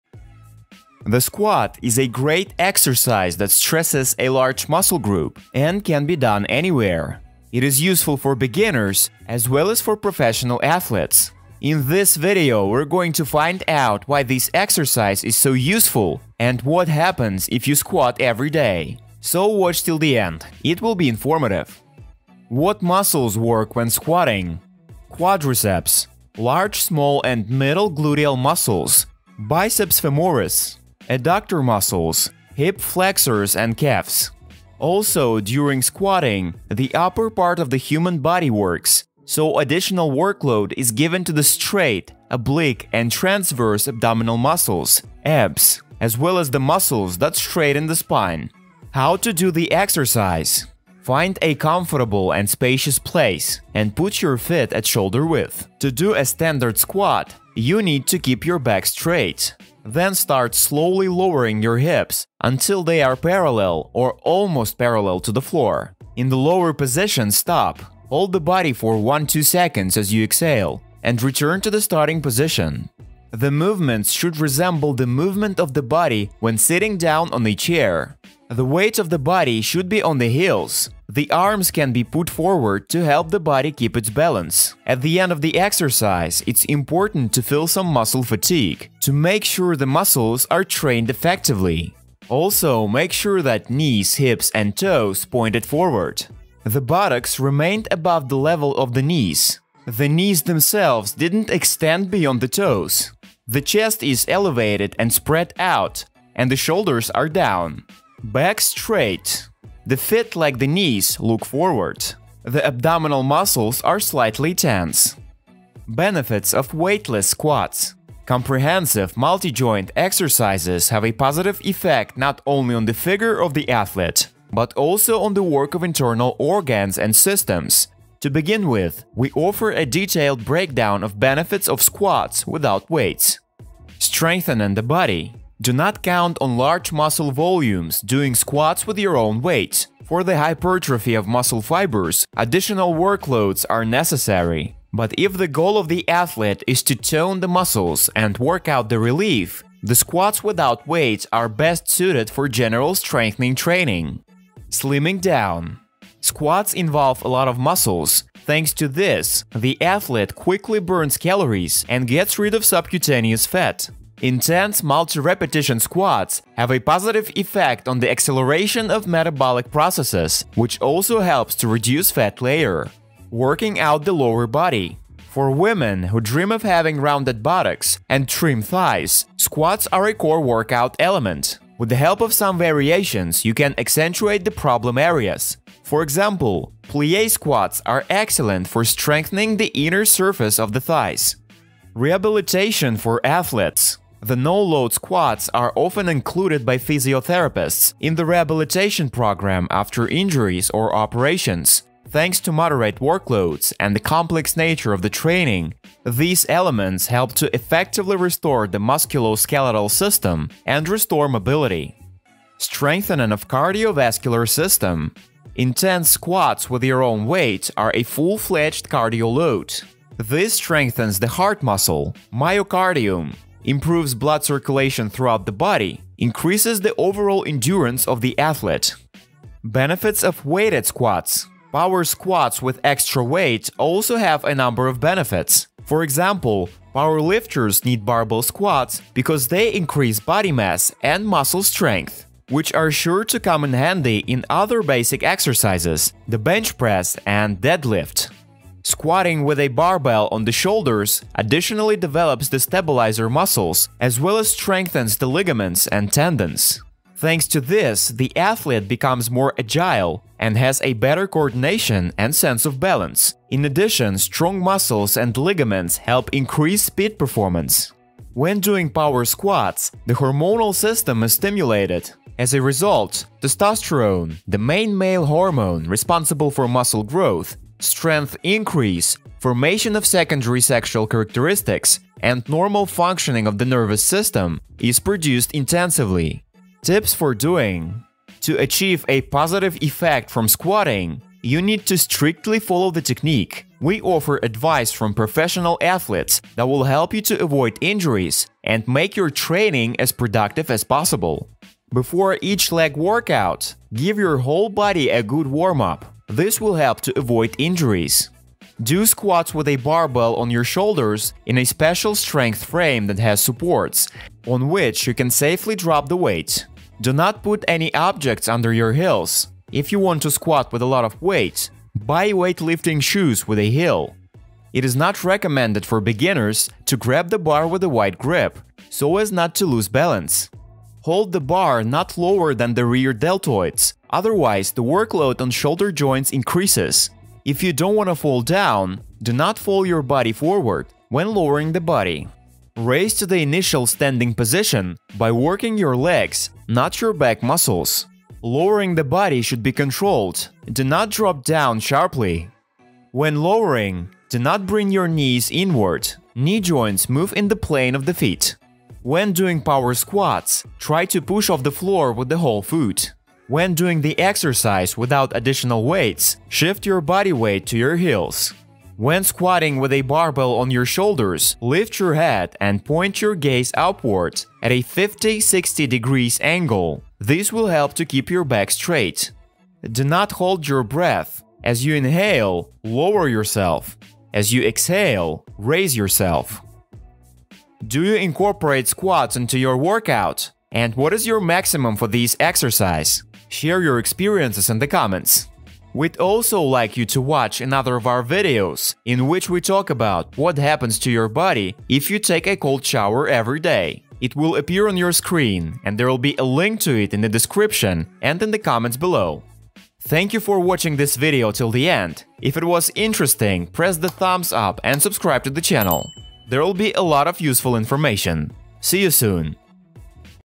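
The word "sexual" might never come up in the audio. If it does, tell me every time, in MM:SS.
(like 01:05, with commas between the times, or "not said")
04:40.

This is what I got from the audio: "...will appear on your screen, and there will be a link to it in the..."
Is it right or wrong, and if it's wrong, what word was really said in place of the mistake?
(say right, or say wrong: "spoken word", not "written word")
right.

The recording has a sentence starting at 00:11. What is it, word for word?
In this video, we're going to find out why this exercise is so useful and what happens if you squat every day.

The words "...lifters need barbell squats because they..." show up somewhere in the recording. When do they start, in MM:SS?
03:57.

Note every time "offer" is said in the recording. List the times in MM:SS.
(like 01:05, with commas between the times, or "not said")
02:09, 04:54.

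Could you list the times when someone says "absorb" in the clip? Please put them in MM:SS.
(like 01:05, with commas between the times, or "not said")
not said.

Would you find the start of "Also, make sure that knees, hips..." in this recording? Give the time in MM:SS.
01:32.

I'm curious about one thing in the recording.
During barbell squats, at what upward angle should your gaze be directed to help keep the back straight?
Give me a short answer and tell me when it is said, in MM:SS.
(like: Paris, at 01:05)
50-60 degrees, at 06:14.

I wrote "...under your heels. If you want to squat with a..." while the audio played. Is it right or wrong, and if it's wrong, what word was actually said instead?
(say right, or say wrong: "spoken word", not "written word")
right.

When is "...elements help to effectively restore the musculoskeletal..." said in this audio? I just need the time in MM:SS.
03:26.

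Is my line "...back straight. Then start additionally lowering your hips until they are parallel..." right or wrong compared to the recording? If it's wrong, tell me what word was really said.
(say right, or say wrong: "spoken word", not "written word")
wrong: "slowly", not "additionally".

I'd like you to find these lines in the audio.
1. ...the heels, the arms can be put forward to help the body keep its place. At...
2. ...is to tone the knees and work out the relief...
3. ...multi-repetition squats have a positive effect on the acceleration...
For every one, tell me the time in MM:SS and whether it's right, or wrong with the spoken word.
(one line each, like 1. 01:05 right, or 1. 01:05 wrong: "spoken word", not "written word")
1. 01:20 wrong: "balance", not "place"
2. 02:26 wrong: "muscles", not "knees"
3. 02:44 right.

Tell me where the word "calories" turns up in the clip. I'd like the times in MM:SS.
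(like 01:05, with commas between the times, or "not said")
02:41.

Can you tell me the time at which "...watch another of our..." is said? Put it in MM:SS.
06:37.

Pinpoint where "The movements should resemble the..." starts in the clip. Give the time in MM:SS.
01:13.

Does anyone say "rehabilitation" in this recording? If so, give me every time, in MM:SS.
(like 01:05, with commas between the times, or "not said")
03:11, 03:18.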